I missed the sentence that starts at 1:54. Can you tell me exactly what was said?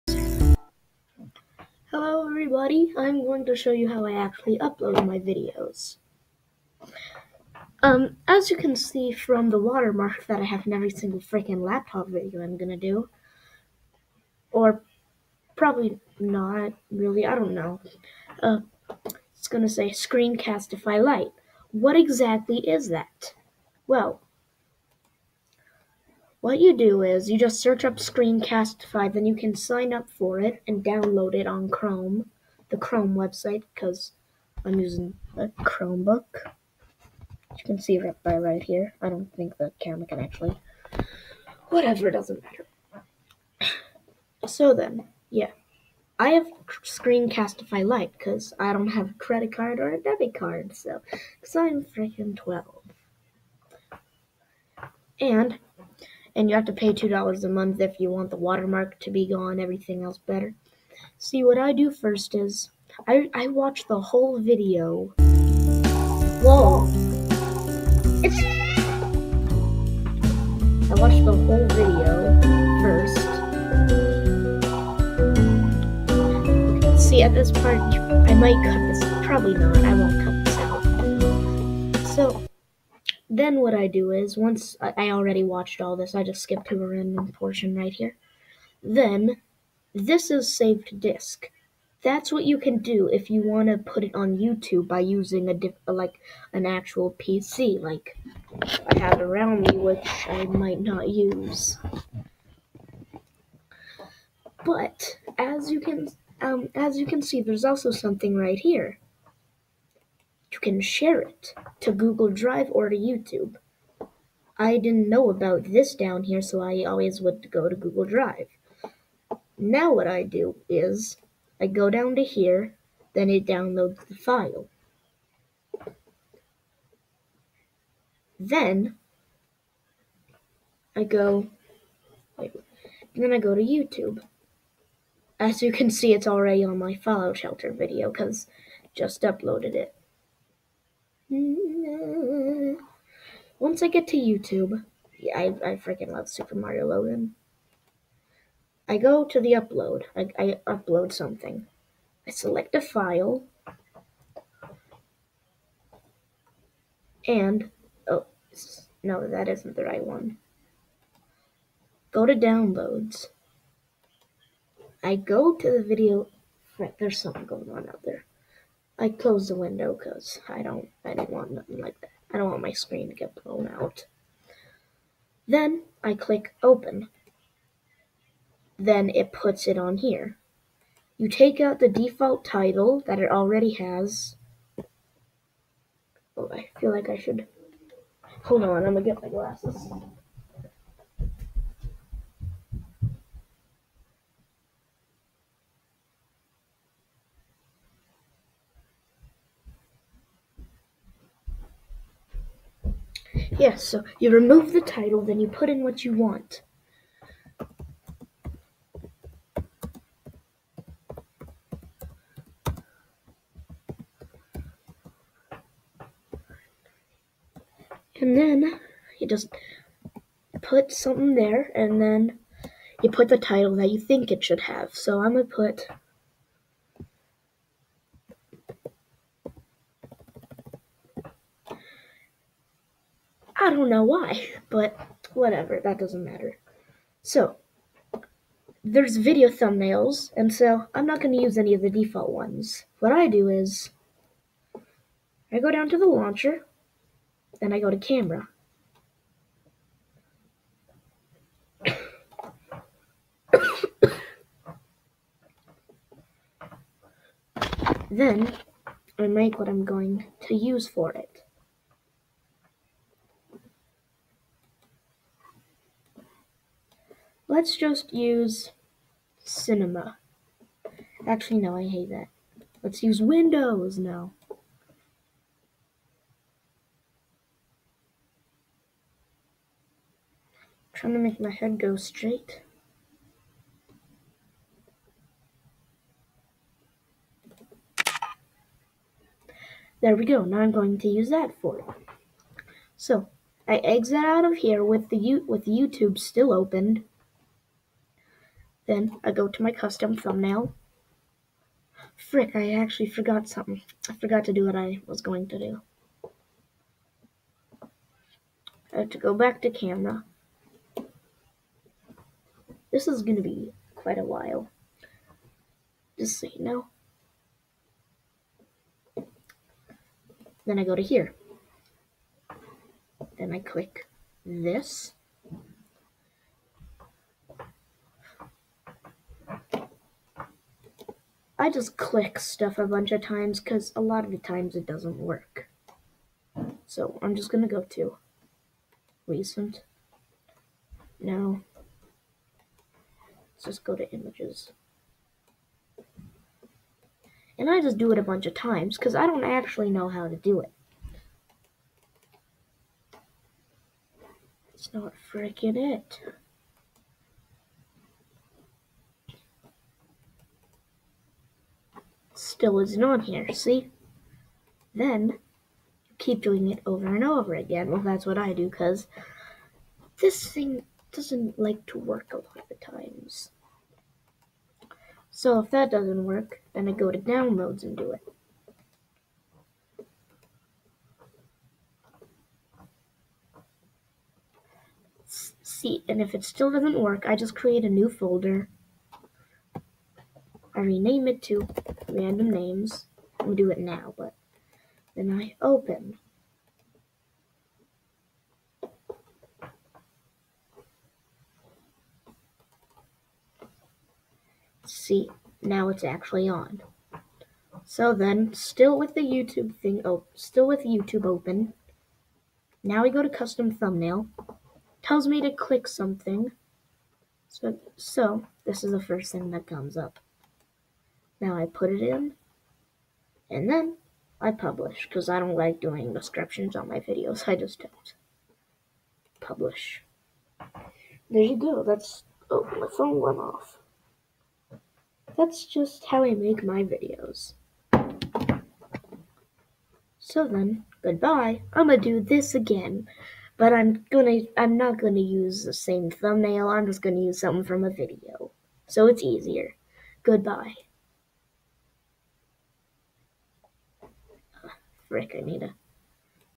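I didn't know about this down here, so I always would go to Google Drive.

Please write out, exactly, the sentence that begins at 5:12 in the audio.
This is going to be quite a while.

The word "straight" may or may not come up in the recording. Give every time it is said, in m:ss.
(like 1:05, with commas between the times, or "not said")
4:41.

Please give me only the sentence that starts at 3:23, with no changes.
Yeah, so you remove the title, then you put in what you want.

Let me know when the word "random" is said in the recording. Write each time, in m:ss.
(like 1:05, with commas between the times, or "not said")
1:26, 6:32.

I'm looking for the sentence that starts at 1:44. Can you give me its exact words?
But as you can um, as you can see, there's also something right here.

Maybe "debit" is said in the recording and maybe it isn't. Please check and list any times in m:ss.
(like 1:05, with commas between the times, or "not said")
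0:50.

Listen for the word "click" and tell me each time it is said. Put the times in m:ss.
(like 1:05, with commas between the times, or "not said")
2:56, 5:23, 5:31, 6:55.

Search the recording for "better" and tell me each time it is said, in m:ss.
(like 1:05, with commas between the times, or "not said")
1:00.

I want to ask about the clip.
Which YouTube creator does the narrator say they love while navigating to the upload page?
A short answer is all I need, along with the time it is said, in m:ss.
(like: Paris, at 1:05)
Super Mario Logan, at 2:26.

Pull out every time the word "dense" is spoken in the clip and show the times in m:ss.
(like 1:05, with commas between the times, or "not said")
not said.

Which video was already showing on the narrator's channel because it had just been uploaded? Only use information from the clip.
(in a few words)
Fallout Shelter.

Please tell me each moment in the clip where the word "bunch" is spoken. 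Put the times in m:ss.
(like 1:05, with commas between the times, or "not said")
5:32, 5:48.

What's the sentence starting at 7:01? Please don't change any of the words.
Now I put it in and then I publish because I don't like doing descriptions on my videos.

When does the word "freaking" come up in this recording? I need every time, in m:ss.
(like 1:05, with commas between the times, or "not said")
0:11, 0:51, 2:25, 5:55.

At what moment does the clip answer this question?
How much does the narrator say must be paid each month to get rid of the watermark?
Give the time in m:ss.
0:56.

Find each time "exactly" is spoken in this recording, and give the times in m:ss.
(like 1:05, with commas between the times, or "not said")
0:21.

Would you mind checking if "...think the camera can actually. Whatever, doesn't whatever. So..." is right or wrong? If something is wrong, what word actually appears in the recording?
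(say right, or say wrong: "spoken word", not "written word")
wrong: "matter", not "whatever".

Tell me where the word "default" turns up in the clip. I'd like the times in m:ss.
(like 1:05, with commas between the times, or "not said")
3:01, 4:01.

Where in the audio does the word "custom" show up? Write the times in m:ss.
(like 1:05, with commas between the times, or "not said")
4:59, 6:53.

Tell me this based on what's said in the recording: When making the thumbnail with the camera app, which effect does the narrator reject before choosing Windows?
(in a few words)
Cinema.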